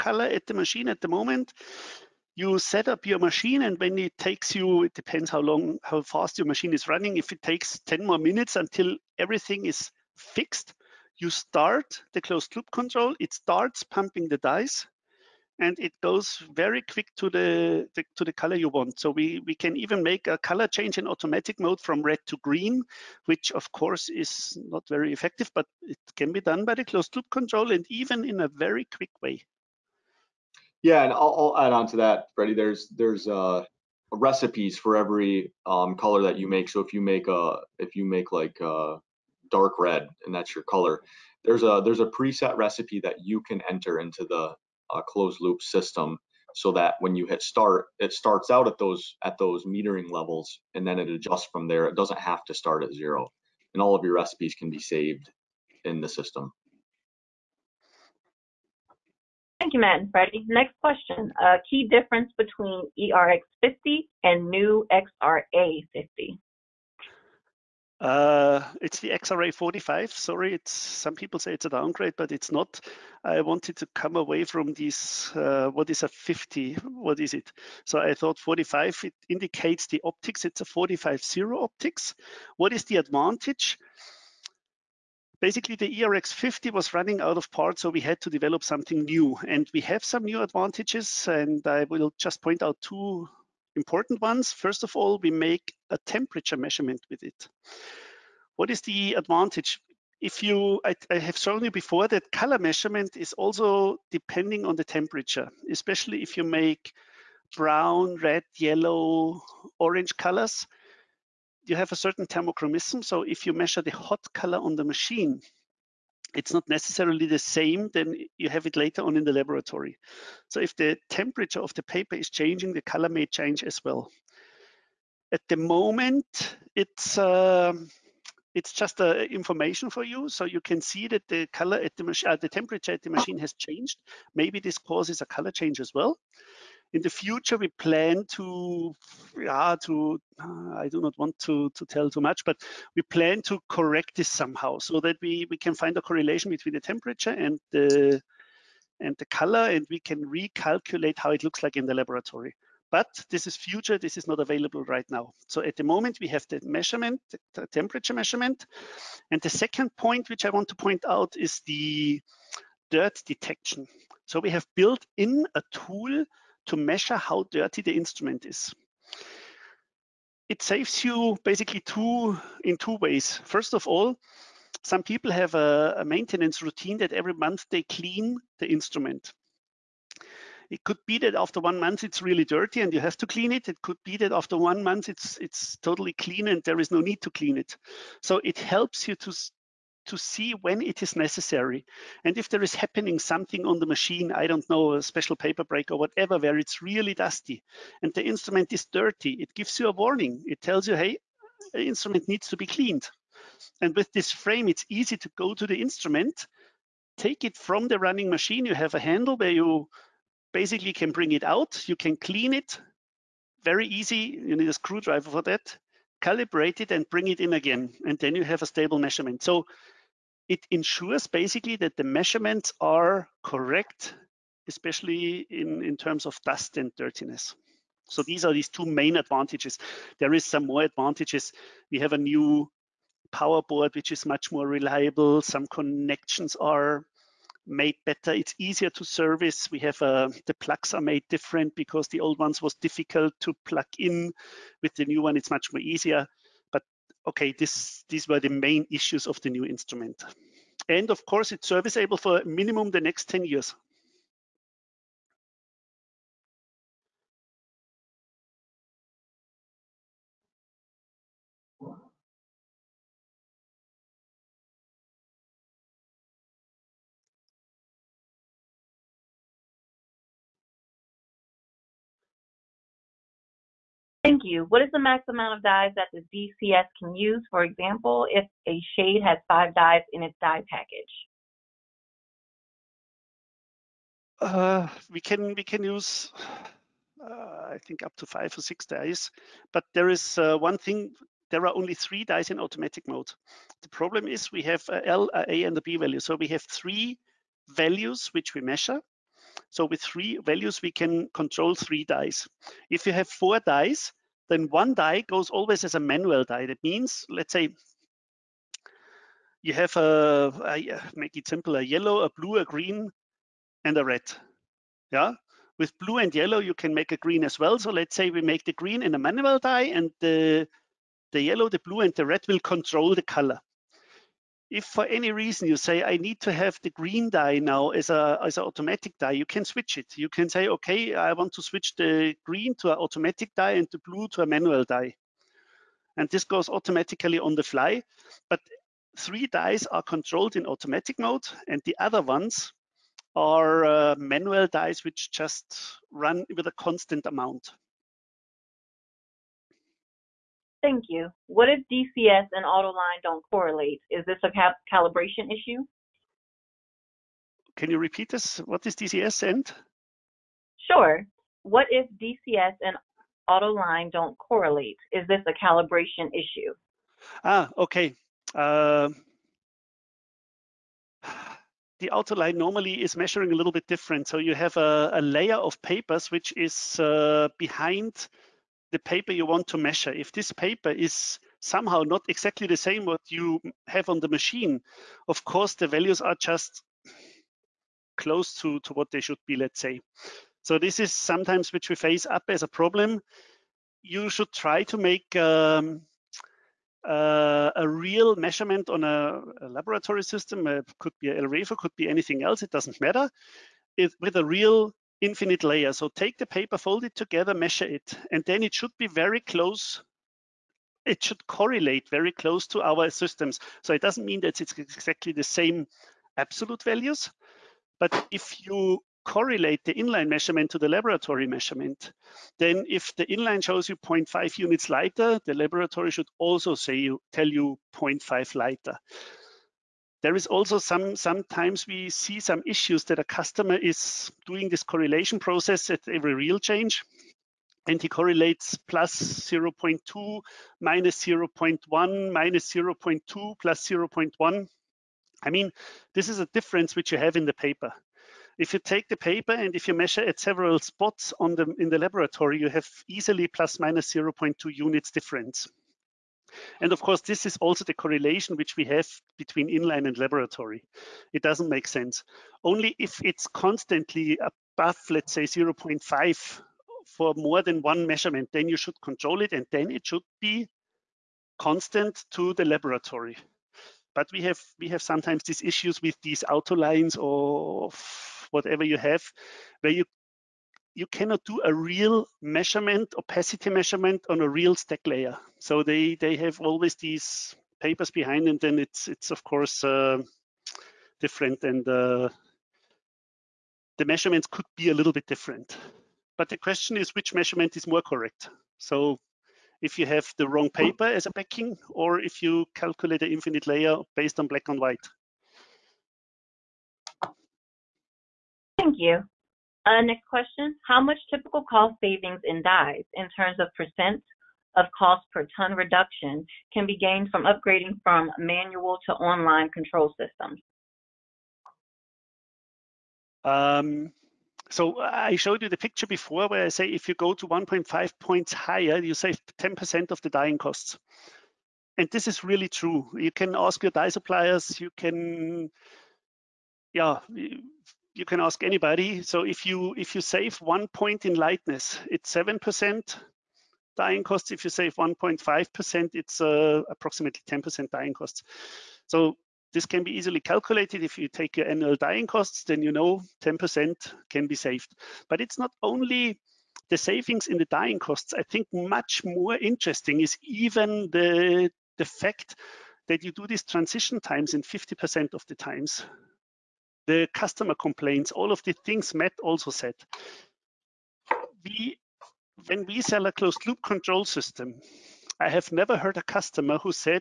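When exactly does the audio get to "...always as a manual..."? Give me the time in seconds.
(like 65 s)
305 s.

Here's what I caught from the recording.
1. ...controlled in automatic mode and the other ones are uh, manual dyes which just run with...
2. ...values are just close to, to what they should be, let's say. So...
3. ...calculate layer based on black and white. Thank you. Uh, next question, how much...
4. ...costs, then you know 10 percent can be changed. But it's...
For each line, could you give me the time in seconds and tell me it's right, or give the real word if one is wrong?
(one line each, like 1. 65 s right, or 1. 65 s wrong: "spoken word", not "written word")
1. 340 s right
2. 385 s right
3. 503 s wrong: "infinite", not "calculate"
4. 552 s wrong: "saved", not "changed".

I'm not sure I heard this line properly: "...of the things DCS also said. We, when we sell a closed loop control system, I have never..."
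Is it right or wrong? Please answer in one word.
wrong.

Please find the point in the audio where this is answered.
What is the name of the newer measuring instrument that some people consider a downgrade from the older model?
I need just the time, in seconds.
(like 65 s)
69 s.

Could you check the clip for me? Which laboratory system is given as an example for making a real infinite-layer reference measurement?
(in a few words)
Elrepho.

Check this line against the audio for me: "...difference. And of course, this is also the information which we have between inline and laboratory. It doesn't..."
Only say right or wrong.
wrong.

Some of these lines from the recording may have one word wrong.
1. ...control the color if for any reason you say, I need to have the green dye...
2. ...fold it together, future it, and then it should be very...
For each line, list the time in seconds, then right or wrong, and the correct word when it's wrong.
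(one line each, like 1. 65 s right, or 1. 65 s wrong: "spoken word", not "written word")
1. 322 s right
2. 406 s wrong: "measure", not "future".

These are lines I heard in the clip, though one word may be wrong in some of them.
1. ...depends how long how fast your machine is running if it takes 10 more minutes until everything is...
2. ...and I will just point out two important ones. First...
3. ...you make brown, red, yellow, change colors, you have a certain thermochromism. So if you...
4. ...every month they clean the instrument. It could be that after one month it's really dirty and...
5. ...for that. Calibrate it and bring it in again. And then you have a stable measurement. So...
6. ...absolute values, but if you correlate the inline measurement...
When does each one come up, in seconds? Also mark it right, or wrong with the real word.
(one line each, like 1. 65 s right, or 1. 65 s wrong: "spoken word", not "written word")
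1. 4 s right
2. 91 s right
3. 106 s wrong: "orange", not "change"
4. 177 s right
5. 215 s right
6. 416 s right.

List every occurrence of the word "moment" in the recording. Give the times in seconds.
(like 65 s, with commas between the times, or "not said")
1 s, 125 s, 155 s.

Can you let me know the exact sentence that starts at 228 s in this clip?
So these are these two main advantages.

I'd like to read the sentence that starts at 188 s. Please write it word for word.
So it helps you to to see when it is necessary.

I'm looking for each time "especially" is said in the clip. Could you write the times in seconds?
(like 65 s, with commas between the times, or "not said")
105 s, 224 s.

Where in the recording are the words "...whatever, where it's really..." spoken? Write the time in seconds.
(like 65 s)
195 s.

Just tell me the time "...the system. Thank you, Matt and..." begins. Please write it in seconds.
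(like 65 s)
56 s.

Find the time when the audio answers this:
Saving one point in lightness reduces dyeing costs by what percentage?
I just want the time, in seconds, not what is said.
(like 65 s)
542 s.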